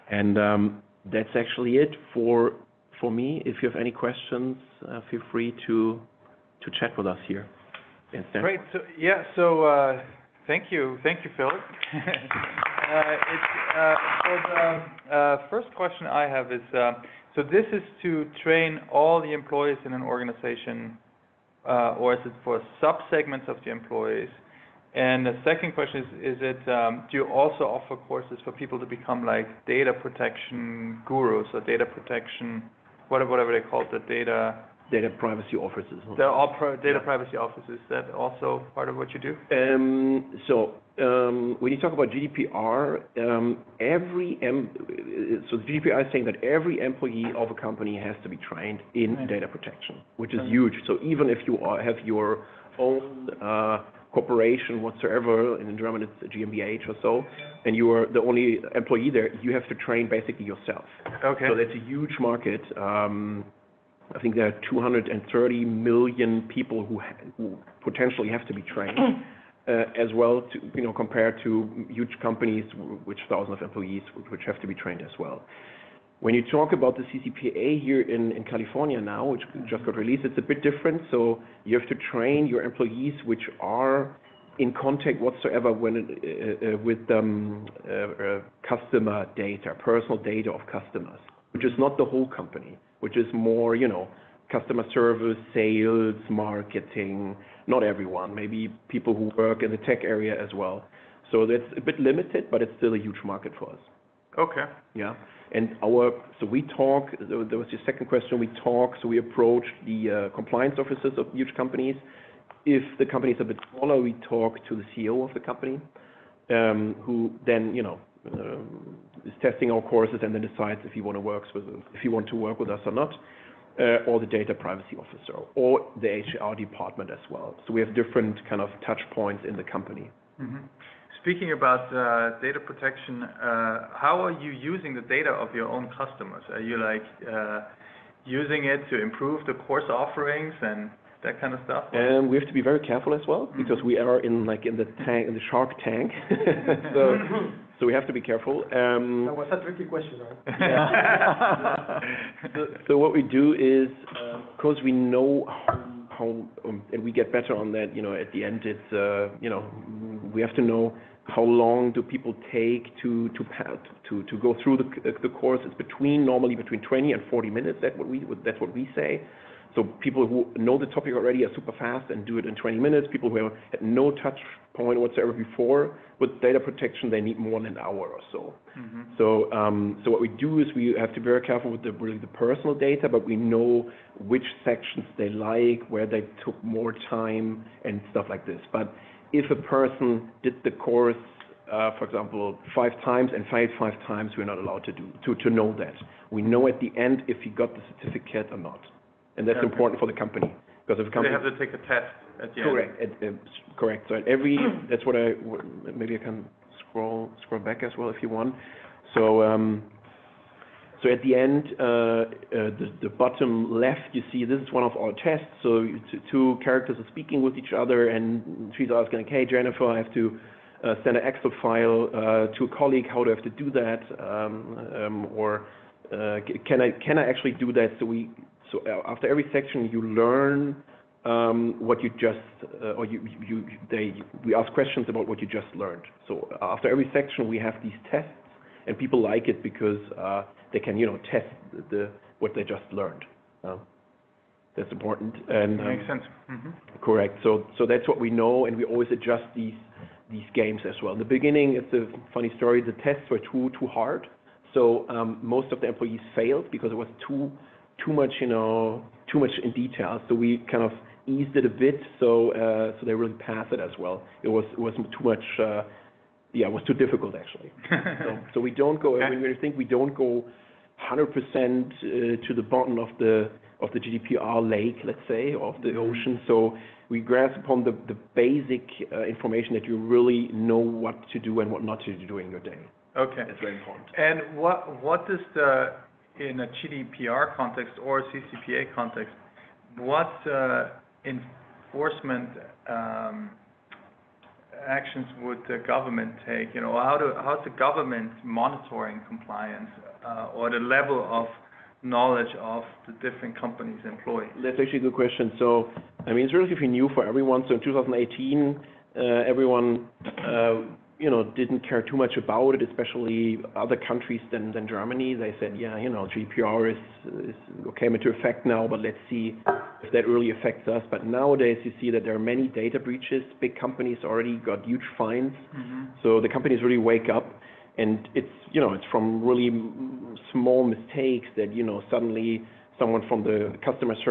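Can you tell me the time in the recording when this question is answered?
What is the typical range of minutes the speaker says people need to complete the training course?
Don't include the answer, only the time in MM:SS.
02:46.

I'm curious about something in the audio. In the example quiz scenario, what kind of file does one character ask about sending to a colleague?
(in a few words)
Excel file.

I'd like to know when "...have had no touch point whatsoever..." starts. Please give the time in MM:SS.
02:53.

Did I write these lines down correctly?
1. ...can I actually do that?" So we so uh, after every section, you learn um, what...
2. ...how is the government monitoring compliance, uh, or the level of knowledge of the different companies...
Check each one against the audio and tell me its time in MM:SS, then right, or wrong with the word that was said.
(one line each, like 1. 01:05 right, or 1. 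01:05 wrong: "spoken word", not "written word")
1. 03:46 right
2. 04:56 right.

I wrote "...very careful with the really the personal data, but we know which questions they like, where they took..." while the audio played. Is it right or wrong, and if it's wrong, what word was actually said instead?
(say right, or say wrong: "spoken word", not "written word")
wrong: "sections", not "questions".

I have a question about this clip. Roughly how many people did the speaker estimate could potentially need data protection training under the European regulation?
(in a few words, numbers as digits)
230 million.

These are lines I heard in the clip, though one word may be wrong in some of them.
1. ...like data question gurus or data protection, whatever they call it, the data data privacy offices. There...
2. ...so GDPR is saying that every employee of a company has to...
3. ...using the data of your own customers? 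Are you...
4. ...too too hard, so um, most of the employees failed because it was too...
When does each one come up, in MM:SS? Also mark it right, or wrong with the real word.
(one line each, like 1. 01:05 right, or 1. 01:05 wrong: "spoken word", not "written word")
1. 00:29 wrong: "protection", not "question"
2. 00:43 right
3. 02:14 right
4. 04:13 right.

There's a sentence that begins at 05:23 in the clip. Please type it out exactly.
Big companies already got huge fines.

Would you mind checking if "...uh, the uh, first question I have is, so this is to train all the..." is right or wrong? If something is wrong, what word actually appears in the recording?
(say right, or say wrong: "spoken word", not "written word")
right.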